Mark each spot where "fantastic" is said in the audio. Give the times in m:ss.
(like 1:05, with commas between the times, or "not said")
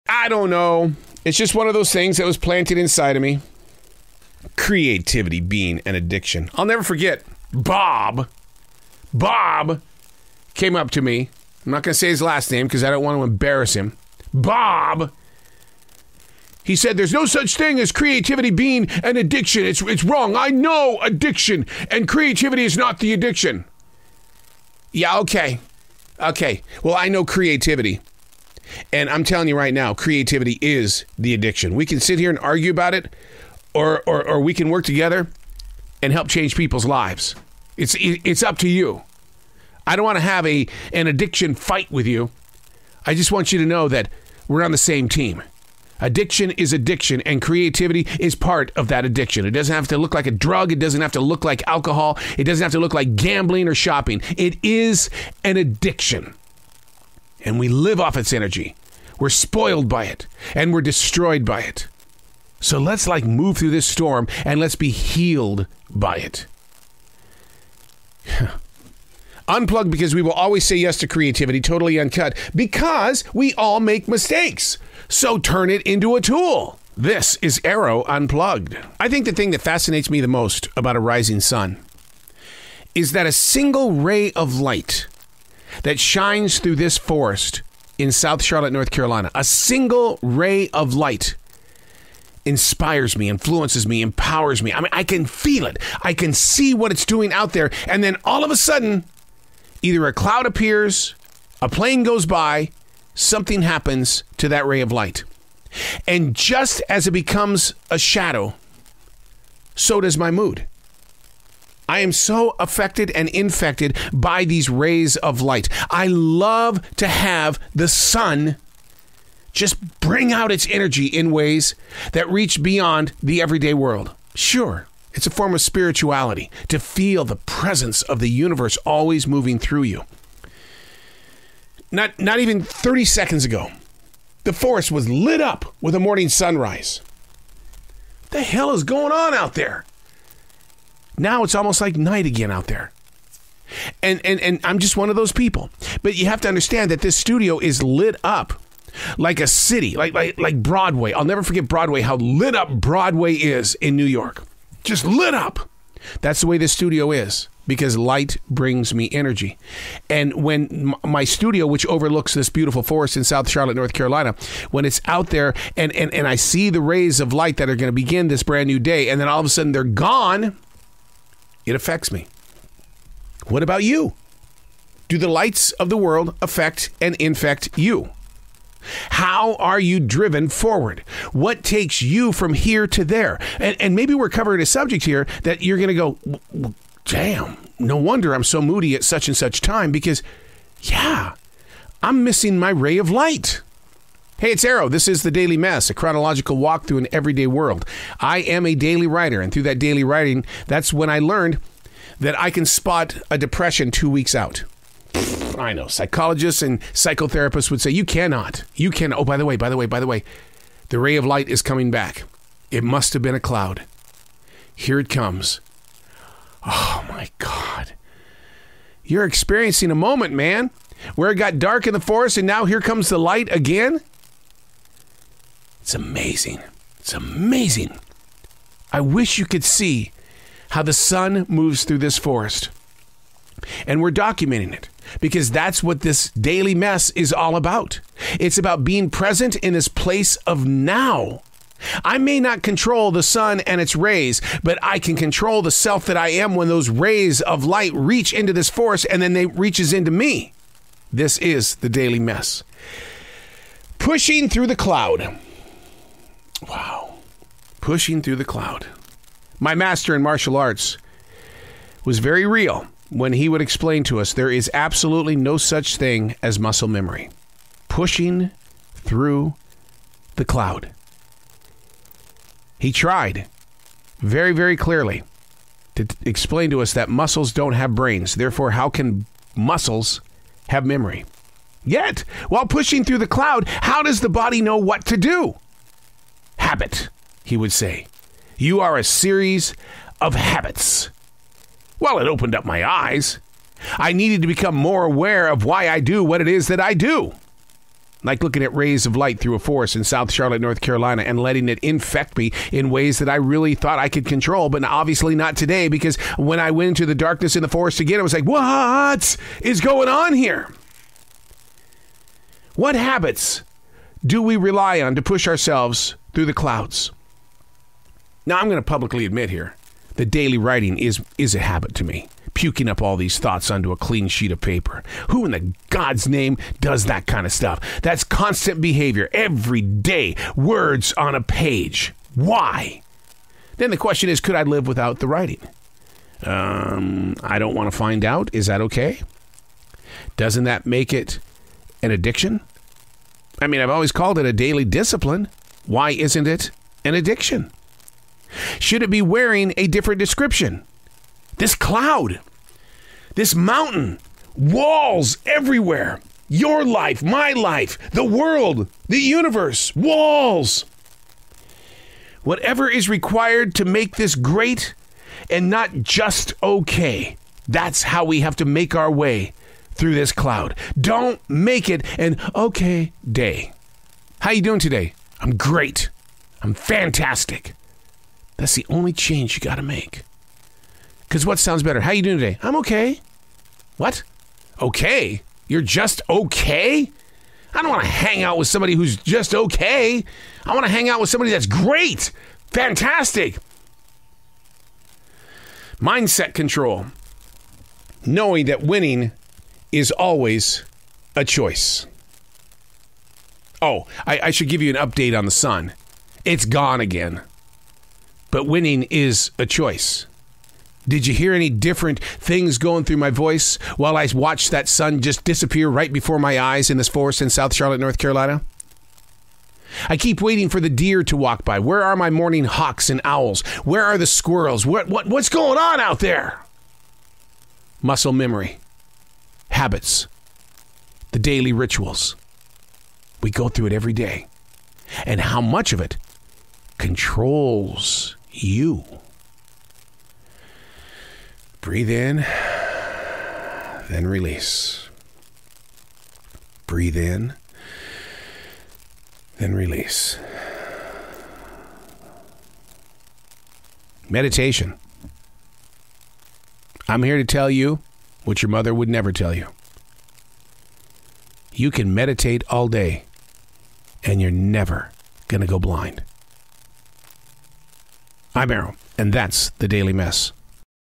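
6:16, 6:32.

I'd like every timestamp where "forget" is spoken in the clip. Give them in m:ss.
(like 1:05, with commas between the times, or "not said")
0:06, 2:31.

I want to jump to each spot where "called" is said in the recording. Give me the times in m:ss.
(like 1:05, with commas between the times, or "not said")
5:44.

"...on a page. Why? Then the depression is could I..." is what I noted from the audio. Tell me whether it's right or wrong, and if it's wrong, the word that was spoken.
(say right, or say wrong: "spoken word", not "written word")
wrong: "question", not "depression".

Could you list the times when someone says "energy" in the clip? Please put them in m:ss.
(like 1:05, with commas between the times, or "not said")
0:58, 2:00, 2:39.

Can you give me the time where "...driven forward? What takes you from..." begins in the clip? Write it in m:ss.
3:00.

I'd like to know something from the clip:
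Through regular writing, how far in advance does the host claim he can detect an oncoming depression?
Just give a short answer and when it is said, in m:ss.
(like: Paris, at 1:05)
2 weeks, at 3:23.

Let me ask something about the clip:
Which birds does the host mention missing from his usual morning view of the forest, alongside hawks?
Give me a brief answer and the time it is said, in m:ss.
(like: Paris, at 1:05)
owls, at 7:03.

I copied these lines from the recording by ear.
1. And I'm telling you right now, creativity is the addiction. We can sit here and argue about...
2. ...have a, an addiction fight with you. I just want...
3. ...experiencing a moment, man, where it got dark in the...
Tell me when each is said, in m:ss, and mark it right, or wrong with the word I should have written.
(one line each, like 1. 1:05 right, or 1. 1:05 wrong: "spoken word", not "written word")
1. 0:28 right
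2. 0:40 right
3. 3:39 right.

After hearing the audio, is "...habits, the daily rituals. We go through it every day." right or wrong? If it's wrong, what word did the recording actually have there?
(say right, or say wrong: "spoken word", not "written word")
right.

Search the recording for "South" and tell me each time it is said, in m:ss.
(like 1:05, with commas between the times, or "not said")
1:28, 2:43, 5:00, 6:57.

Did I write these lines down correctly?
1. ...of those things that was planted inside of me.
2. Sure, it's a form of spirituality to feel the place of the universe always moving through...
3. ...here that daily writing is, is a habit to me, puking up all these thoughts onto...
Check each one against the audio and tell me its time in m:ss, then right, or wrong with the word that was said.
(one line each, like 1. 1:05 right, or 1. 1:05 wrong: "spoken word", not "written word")
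1. 0:01 right
2. 2:04 wrong: "presence", not "place"
3. 5:19 right.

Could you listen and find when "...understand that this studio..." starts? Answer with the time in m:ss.
2:26.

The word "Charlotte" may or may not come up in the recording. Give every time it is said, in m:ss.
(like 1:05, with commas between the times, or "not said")
1:28, 2:43, 5:00, 6:57.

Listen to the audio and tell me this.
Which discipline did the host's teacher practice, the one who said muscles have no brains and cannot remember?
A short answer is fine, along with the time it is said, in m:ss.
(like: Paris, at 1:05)
martial arts, at 4:20.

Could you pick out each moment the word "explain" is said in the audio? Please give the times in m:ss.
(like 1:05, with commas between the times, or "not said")
4:23, 4:36.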